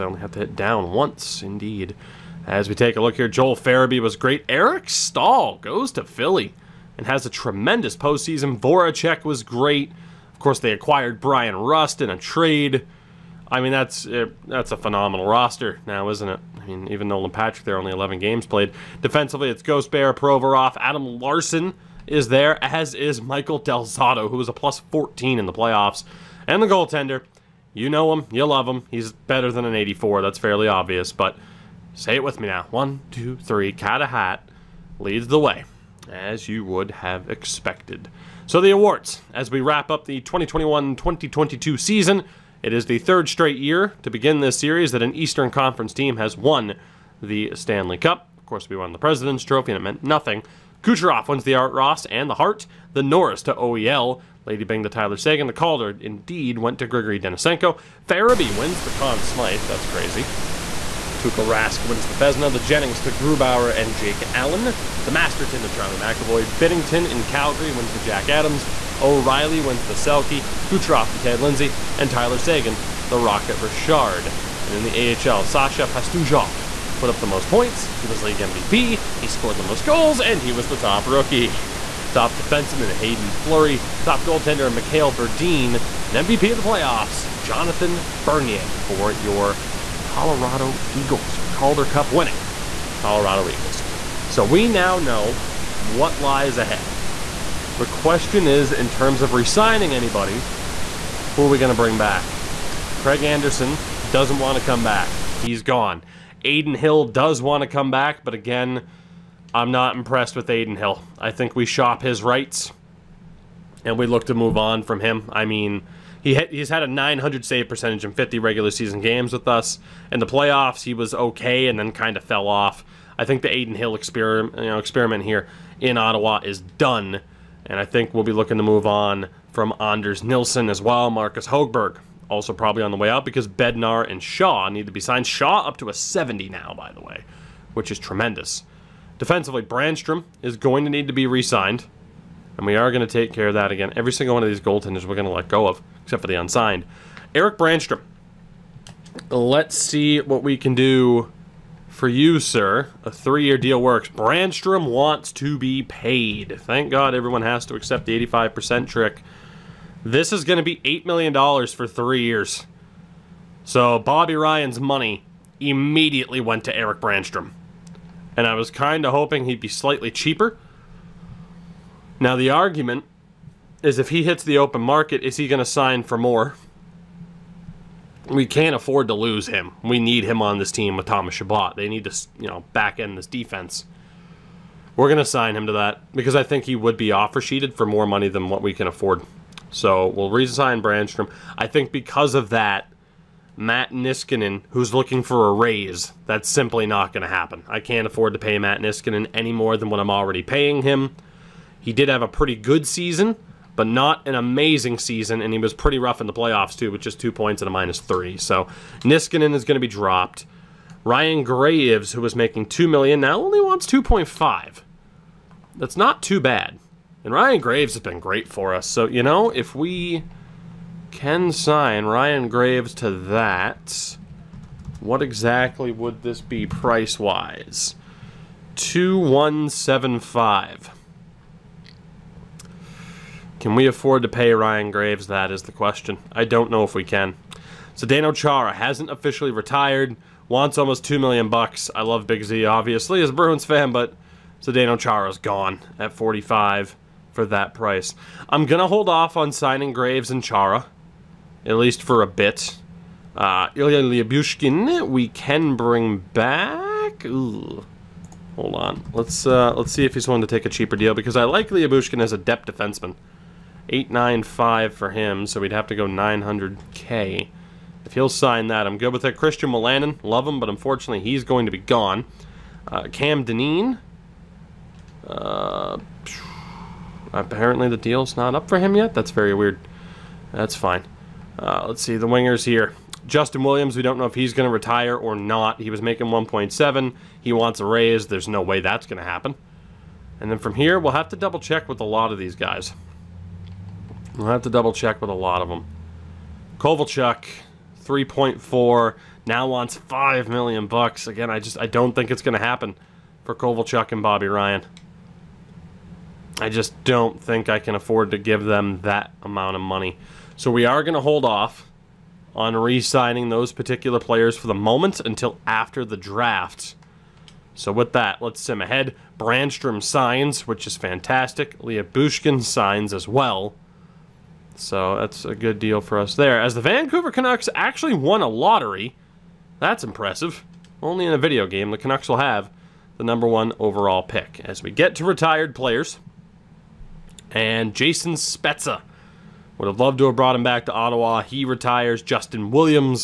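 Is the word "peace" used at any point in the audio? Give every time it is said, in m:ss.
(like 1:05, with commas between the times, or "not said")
not said.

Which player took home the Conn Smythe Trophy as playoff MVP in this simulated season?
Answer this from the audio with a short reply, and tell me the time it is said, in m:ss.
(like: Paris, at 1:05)
Joel Farabee, at 0:58.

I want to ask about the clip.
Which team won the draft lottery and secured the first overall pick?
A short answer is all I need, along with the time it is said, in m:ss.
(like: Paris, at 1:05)
Vancouver Canucks, at 5:26.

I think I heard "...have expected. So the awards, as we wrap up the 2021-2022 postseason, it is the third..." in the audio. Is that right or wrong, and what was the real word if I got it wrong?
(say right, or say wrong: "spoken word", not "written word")
wrong: "season", not "postseason".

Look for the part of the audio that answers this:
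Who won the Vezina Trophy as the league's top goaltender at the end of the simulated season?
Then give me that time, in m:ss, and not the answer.
1:01.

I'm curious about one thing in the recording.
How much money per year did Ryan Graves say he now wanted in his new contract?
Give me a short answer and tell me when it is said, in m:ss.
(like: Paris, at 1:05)
2.5 million, at 3:33.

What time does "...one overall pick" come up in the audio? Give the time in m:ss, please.
5:33.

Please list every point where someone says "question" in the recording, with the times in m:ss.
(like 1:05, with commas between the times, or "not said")
1:37, 3:55.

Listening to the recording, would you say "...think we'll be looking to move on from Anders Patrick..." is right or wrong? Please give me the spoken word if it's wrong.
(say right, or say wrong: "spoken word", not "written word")
wrong: "Nilsson", not "Patrick".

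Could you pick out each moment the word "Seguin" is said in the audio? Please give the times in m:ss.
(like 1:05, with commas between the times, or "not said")
0:55, 1:12.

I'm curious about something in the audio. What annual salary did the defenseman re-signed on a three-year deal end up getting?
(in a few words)
$8 million.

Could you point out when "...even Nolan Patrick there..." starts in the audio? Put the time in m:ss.
0:16.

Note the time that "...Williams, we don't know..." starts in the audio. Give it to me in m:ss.
4:43.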